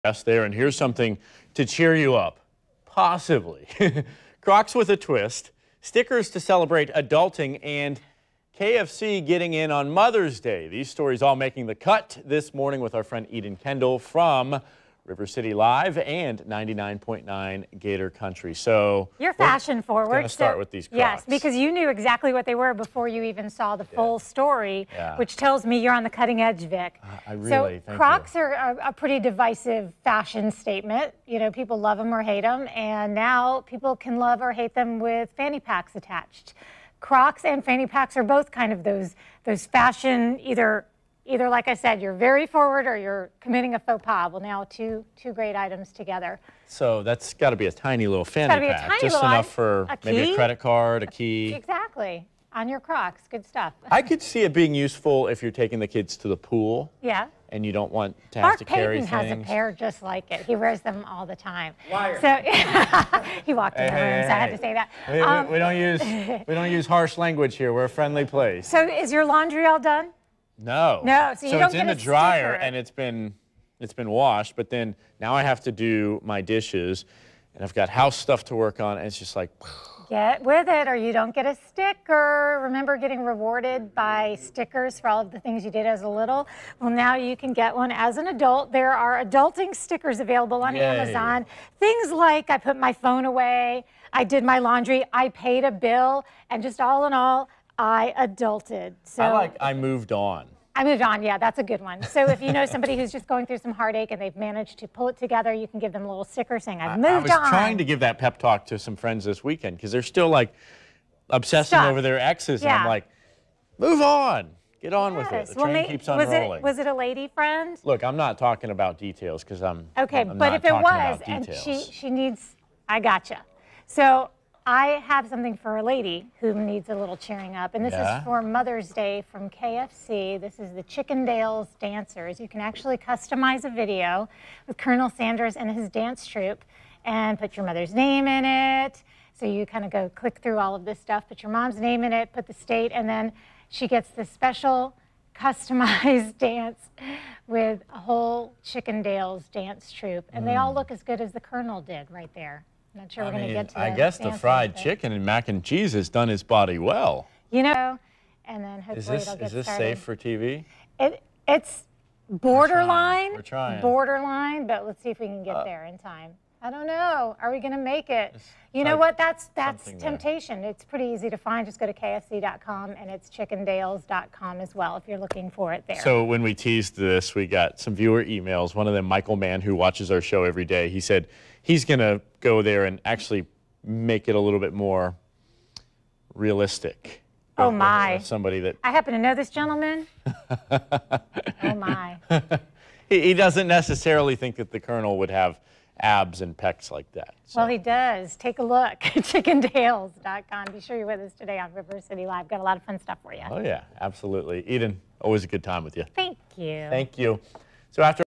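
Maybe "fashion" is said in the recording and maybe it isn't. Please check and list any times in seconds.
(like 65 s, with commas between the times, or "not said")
19 s, 30 s, 39 s.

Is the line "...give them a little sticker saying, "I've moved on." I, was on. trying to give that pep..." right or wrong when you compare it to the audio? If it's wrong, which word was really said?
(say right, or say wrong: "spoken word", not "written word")
right.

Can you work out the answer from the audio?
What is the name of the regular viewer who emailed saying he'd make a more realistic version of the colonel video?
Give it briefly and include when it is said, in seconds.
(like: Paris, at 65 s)
Michael Mann, at 179 s.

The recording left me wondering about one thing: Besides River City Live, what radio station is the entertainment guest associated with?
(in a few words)
99.9 Gator Country.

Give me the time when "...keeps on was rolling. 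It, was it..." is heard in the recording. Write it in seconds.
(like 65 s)
115 s.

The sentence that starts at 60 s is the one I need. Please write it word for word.
He wears them all the time.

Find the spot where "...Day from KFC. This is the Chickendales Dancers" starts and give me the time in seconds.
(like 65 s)
128 s.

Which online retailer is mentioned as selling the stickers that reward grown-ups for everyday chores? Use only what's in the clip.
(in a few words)
Amazon.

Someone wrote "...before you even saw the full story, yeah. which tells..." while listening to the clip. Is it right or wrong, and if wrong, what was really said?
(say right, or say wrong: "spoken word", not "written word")
right.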